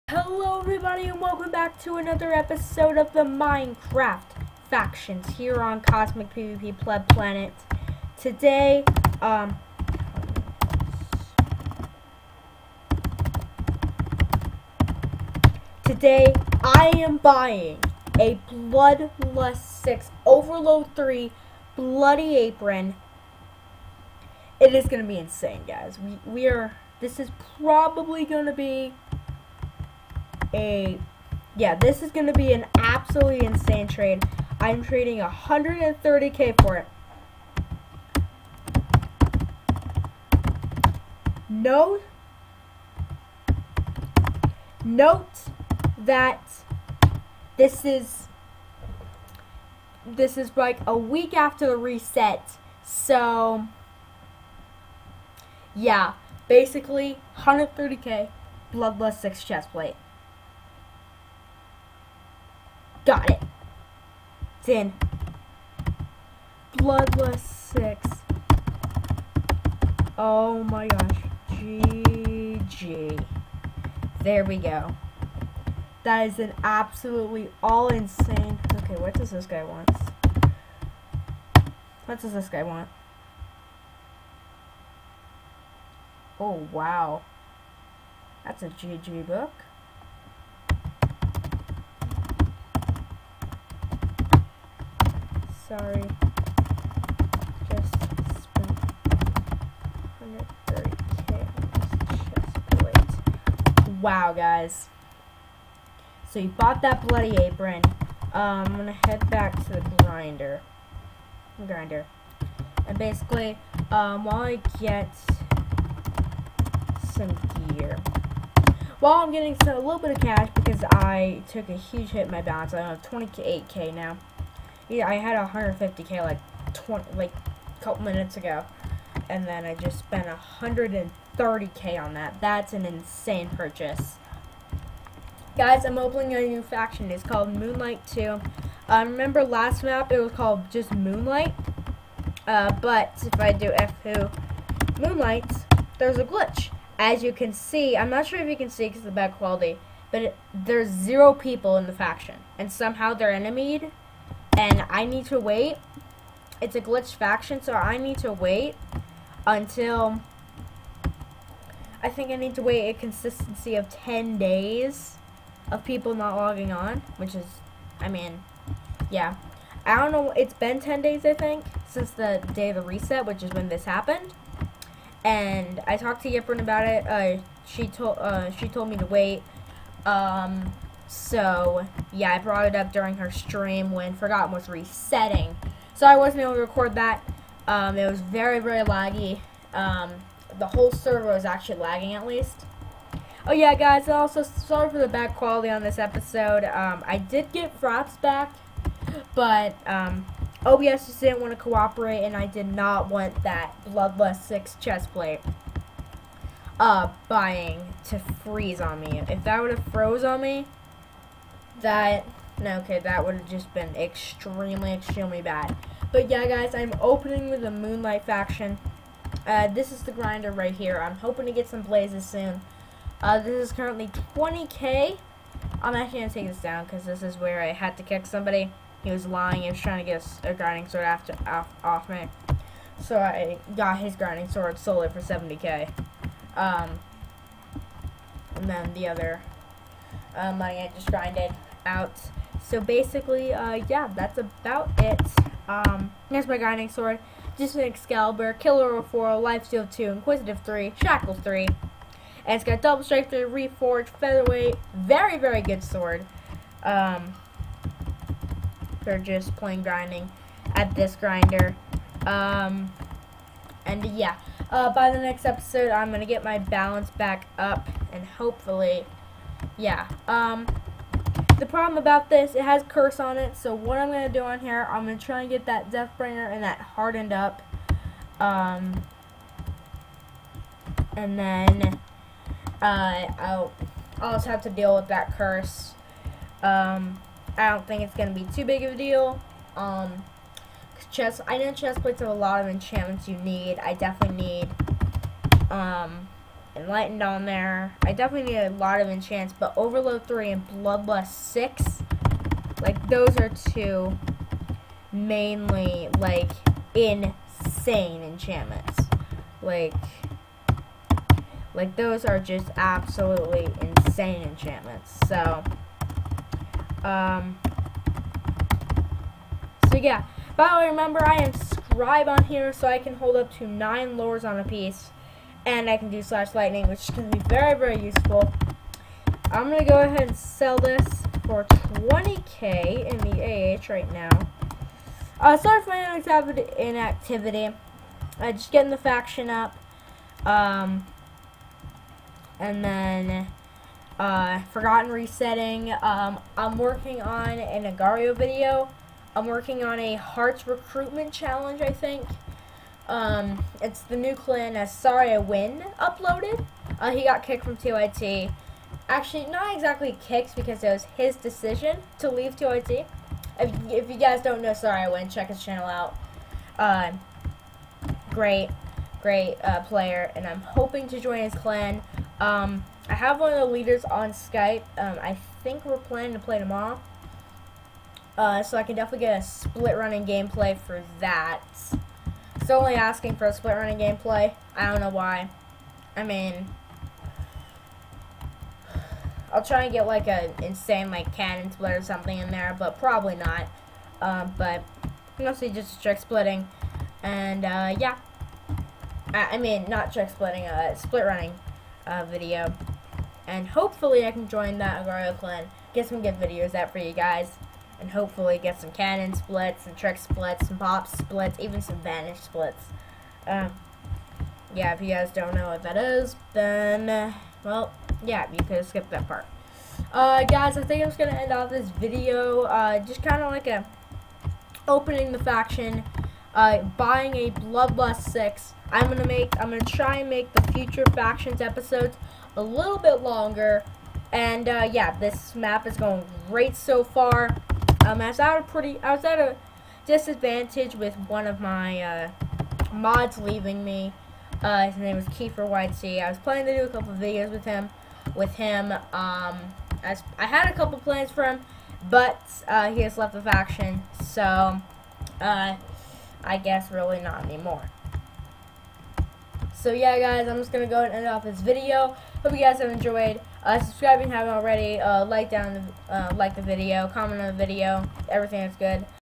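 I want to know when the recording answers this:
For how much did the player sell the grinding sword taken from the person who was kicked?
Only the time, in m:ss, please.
3:55.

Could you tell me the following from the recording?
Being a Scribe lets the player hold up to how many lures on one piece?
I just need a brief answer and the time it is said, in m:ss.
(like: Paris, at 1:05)
9, at 5:23.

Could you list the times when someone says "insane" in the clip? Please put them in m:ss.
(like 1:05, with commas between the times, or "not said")
0:25, 0:33, 1:17, 2:12, 5:06, 5:13, 6:30.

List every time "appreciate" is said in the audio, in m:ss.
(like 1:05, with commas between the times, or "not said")
not said.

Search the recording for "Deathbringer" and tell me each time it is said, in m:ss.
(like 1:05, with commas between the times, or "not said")
4:35.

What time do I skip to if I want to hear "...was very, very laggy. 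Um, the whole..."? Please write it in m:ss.
3:08.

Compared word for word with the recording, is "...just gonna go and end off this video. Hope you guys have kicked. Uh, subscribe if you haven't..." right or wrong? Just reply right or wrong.
wrong.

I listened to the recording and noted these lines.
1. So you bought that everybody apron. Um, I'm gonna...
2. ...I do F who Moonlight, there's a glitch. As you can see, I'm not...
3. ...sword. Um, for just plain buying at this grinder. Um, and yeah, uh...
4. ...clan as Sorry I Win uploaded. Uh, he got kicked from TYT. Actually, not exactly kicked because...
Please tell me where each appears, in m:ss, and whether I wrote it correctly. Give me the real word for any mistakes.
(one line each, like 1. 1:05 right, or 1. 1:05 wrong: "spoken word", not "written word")
1. 1:46 wrong: "bloody", not "everybody"
2. 2:23 right
3. 4:15 wrong: "grinding", not "buying"
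4. 5:54 right.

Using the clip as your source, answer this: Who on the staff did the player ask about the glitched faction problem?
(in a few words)
Yiprin.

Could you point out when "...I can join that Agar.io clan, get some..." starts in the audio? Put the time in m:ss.
6:44.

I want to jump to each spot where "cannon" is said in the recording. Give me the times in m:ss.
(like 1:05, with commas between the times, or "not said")
6:31, 6:48.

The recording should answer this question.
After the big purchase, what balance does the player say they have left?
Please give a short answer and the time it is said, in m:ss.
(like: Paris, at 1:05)
28k, at 2:03.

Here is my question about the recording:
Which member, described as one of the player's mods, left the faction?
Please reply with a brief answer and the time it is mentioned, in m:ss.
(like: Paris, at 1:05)
Kiefer YC, at 7:25.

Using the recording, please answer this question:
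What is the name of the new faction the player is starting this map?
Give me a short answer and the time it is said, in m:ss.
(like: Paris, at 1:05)
Moonlight 2, at 2:17.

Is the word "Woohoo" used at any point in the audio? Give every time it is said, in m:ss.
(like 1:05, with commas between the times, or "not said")
not said.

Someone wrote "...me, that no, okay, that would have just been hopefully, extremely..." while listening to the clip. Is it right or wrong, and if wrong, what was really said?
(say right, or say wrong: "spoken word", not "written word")
wrong: "extremely", not "hopefully".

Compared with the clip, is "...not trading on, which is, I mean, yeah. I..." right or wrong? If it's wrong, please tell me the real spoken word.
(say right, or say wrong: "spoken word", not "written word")
wrong: "logging", not "trading".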